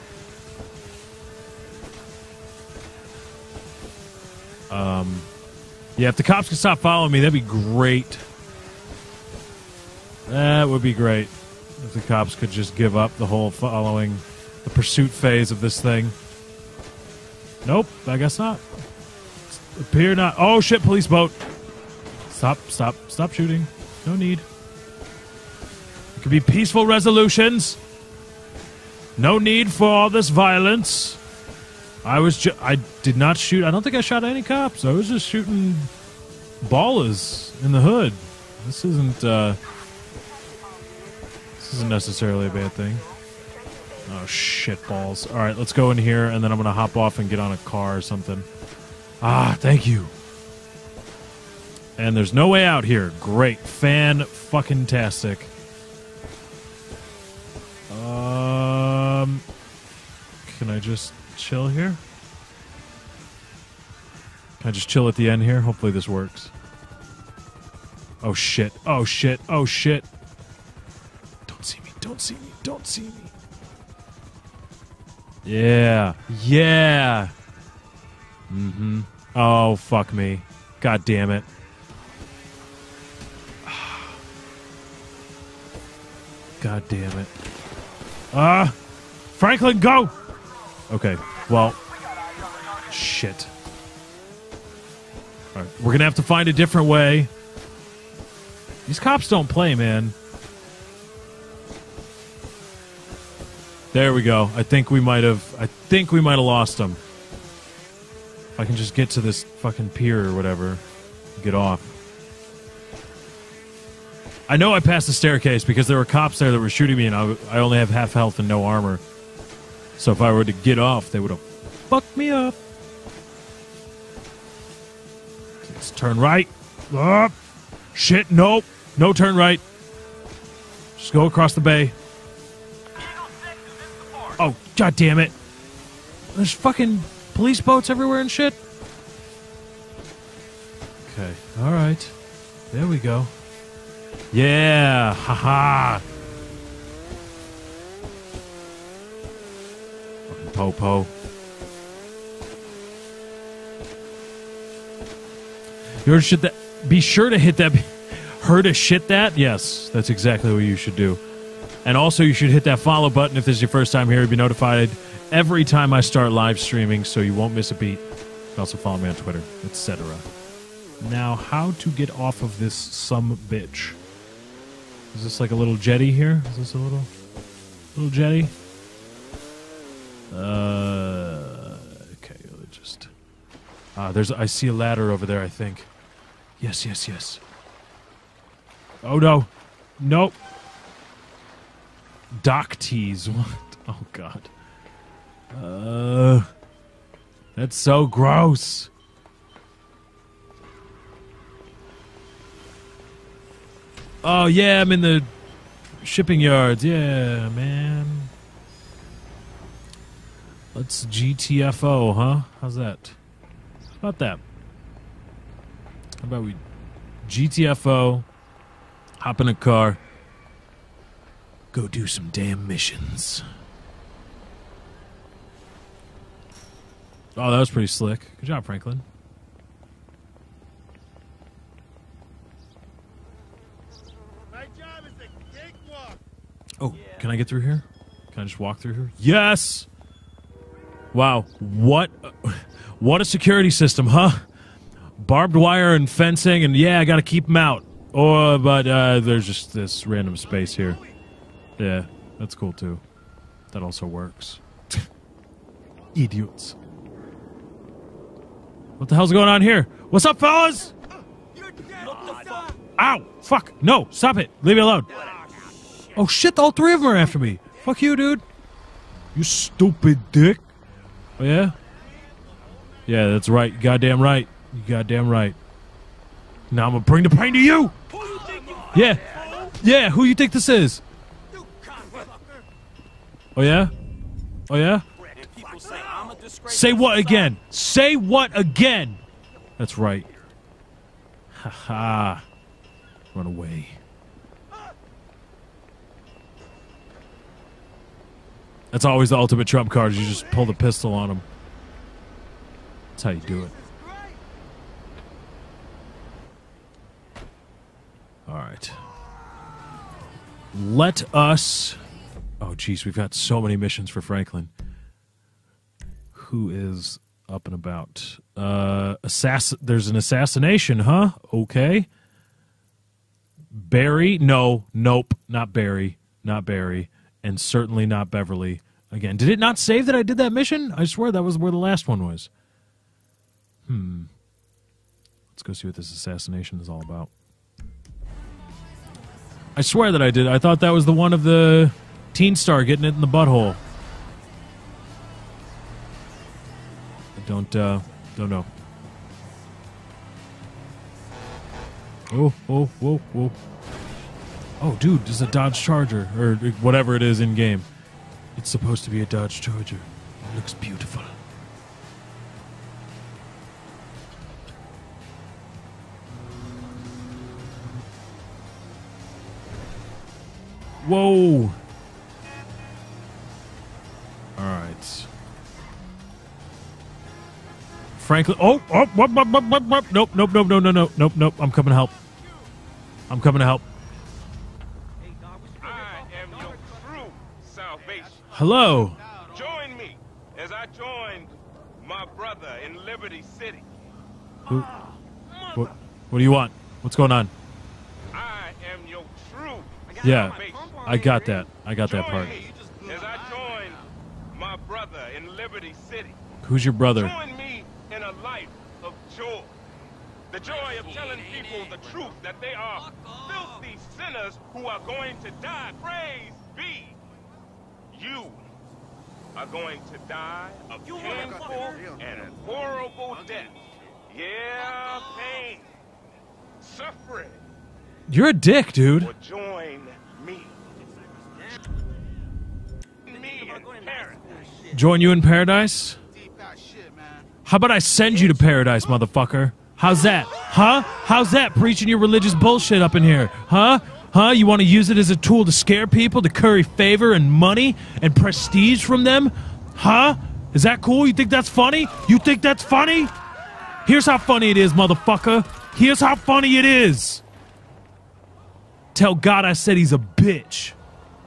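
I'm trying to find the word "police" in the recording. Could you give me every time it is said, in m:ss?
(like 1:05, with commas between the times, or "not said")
0:20, 2:17.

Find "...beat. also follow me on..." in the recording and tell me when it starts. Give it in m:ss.
2:47.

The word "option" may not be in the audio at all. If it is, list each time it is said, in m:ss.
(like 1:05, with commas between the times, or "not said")
not said.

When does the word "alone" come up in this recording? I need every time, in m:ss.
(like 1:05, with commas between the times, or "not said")
4:24.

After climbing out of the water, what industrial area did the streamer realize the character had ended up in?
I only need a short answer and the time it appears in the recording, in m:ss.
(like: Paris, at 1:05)
shipping yards, at 3:26.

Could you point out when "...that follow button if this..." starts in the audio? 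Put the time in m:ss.
2:42.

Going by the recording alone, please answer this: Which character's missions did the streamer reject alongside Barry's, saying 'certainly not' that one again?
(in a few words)
Beverly.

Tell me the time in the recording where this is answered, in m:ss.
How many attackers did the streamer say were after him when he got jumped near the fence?
4:26.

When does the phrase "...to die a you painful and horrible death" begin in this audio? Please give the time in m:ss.
7:00.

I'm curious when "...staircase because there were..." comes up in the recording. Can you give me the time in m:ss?
1:55.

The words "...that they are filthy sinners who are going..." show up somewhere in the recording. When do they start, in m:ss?
6:52.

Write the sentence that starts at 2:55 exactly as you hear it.
Is this like a little jetty here?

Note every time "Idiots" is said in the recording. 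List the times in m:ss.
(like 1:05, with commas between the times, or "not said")
4:16.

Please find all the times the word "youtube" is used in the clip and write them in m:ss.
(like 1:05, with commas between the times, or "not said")
not said.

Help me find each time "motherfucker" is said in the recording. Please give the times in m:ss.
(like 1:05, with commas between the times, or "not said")
7:19, 7:34.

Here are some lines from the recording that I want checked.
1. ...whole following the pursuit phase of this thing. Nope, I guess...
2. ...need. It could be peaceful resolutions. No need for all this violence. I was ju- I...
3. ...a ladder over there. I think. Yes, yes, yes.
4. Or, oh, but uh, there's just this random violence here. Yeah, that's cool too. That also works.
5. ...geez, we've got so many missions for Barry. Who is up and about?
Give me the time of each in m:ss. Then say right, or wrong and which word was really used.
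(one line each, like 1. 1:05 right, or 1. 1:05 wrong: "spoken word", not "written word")
1. 0:13 right
2. 0:24 right
3. 3:04 right
4. 4:08 wrong: "space", not "violence"
5. 5:12 wrong: "Franklin", not "Barry".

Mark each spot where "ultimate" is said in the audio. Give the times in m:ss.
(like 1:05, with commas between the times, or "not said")
4:59.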